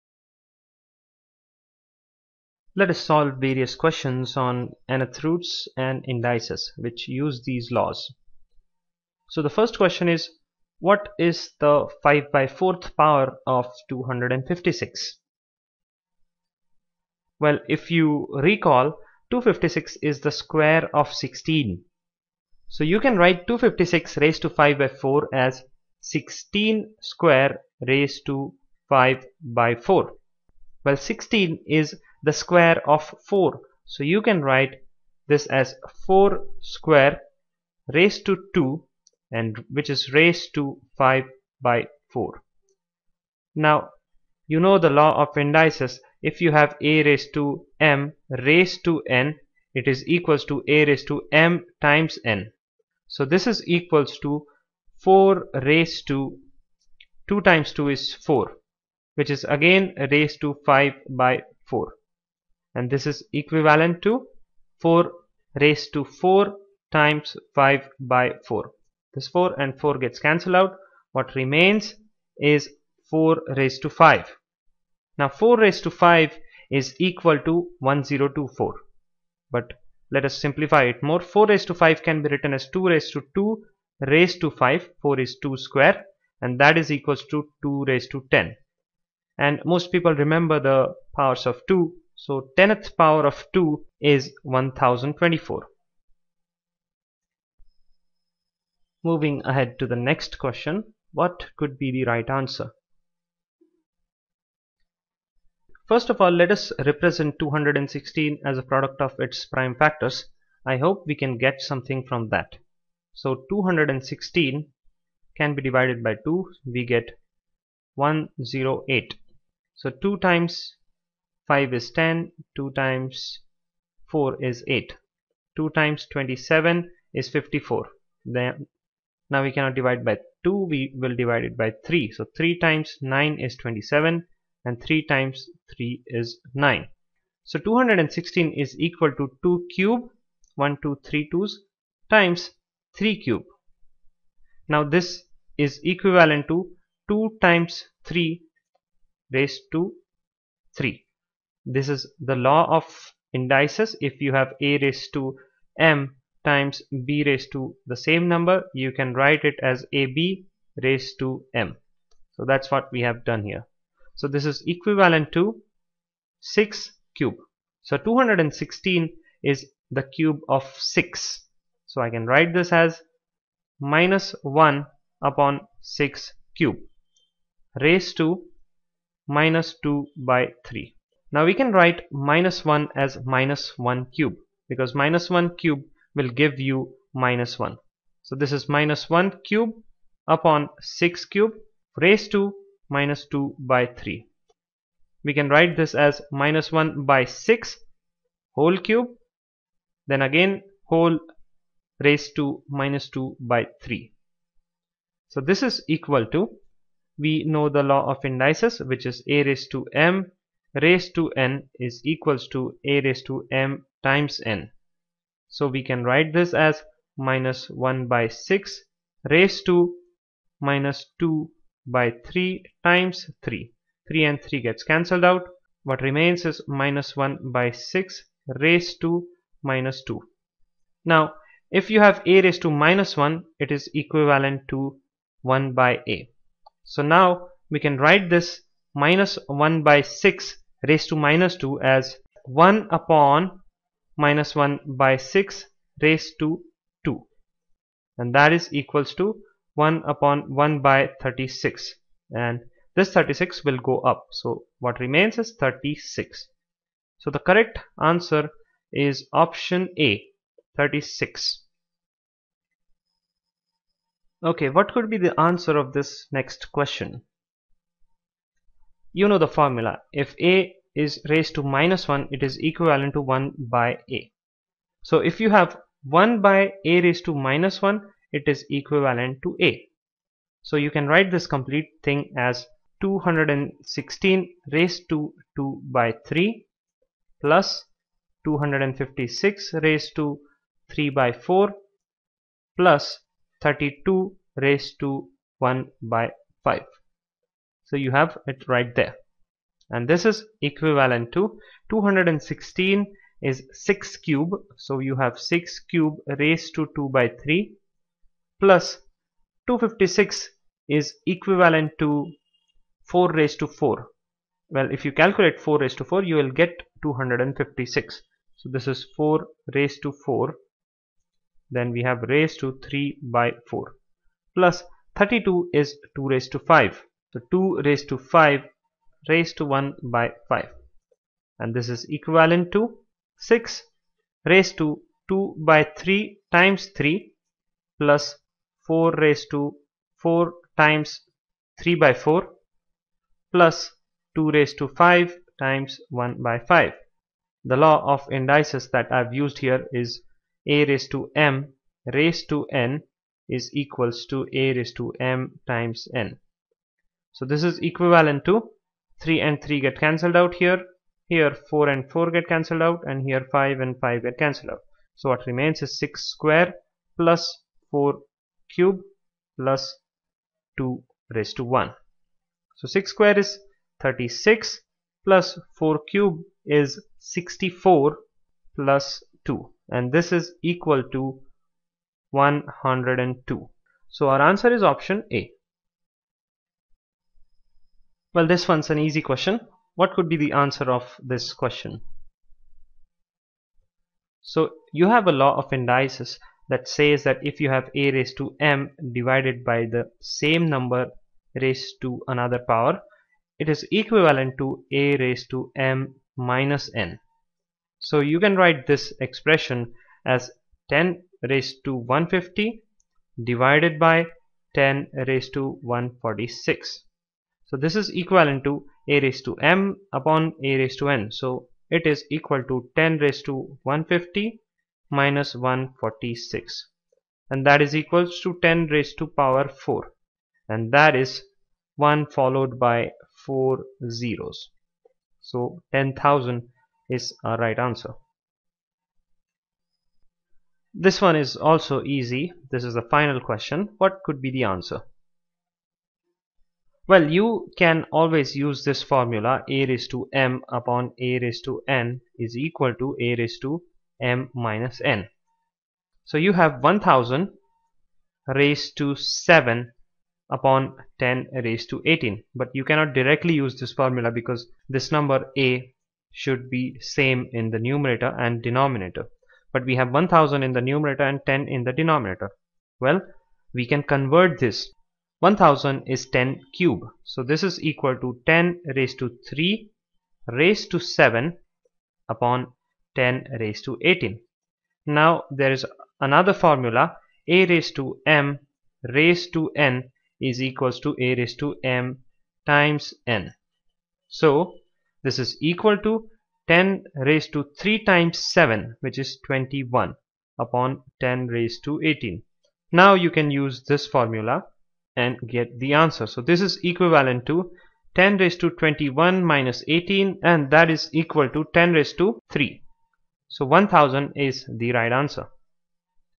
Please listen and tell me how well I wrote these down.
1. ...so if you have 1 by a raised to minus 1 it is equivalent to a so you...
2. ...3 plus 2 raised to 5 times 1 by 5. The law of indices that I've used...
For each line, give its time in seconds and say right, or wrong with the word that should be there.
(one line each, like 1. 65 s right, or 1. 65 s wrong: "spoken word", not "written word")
1. 275 s right
2. 342 s wrong: "4", not "3".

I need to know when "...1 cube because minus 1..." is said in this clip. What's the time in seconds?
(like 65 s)
183 s.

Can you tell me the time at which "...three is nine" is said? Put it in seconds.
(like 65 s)
135 s.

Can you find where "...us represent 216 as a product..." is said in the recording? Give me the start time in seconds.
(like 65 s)
106 s.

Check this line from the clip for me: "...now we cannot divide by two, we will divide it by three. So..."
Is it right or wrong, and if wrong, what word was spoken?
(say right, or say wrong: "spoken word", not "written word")
right.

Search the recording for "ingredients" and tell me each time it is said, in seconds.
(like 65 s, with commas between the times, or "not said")
not said.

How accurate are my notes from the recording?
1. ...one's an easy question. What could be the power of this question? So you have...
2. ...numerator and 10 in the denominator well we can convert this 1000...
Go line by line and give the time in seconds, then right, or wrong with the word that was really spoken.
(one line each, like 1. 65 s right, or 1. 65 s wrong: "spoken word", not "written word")
1. 388 s wrong: "answer", not "power"
2. 470 s right.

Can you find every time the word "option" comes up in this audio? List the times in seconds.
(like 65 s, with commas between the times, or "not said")
259 s, 384 s.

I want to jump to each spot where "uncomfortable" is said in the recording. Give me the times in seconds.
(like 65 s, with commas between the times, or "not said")
not said.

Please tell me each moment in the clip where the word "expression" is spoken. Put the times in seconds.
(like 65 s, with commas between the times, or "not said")
409 s.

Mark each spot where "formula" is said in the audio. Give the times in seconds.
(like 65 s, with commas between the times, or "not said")
269 s, 449 s, 463 s, 486 s, 504 s.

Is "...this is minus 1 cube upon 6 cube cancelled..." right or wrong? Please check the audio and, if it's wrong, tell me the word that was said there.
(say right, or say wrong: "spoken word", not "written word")
wrong: "raised", not "cancelled".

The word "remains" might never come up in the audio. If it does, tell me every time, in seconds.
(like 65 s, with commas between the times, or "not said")
71 s, 226 s, 254 s, 365 s.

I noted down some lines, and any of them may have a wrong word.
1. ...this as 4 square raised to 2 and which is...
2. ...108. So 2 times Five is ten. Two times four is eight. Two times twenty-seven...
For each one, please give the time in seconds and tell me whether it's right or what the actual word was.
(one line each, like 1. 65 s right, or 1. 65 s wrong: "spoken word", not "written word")
1. 35 s right
2. 117 s right.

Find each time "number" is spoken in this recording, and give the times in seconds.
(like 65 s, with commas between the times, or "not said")
158 s, 400 s, 465 s.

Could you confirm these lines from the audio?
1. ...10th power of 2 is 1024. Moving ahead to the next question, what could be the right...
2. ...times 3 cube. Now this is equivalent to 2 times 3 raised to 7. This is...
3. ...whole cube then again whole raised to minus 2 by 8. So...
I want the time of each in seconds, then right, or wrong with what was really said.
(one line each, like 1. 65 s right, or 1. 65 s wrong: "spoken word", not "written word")
1. 92 s right
2. 142 s wrong: "3", not "7"
3. 198 s wrong: "3", not "8".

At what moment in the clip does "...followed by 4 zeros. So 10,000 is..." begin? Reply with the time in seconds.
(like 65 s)
432 s.